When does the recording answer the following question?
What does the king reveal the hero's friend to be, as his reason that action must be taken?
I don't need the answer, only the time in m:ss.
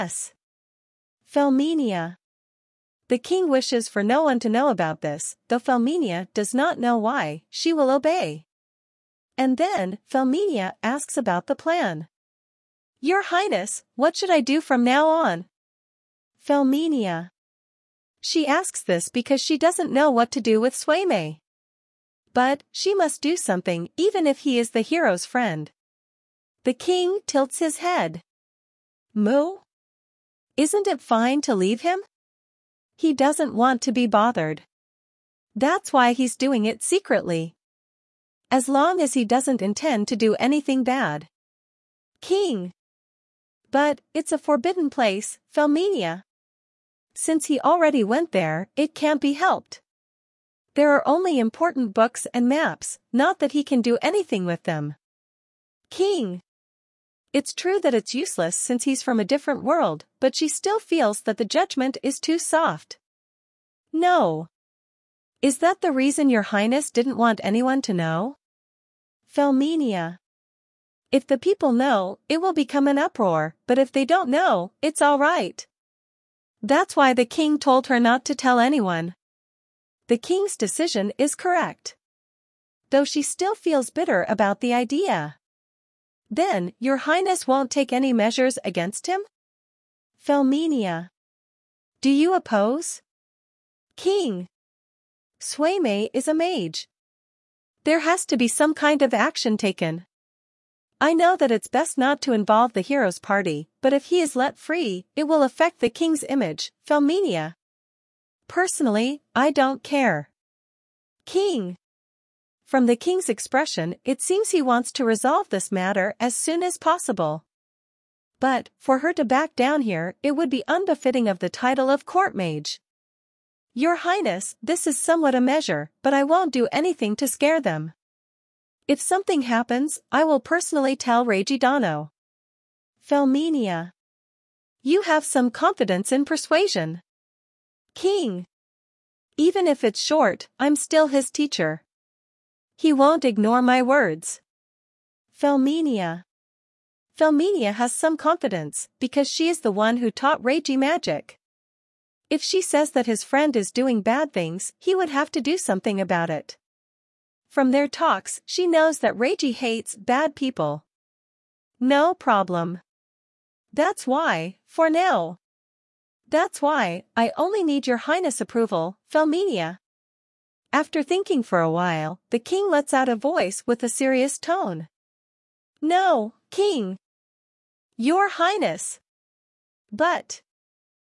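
1:36.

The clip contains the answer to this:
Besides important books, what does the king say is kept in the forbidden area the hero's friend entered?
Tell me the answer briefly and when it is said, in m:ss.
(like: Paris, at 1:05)
Maps, at 0:52.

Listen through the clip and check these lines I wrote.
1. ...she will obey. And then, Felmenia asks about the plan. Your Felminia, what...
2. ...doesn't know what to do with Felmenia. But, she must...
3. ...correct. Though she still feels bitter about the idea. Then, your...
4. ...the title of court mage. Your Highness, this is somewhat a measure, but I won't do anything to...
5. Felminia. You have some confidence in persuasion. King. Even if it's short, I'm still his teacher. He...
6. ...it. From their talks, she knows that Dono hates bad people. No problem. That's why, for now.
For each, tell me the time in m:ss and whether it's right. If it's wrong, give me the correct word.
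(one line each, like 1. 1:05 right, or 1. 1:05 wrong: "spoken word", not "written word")
1. 0:07 wrong: "Highness", not "Felminia"
2. 0:19 wrong: "Suimei", not "Felmenia"
3. 1:21 right
4. 2:01 right
5. 2:13 right
6. 2:36 wrong: "Reiji", not "Dono".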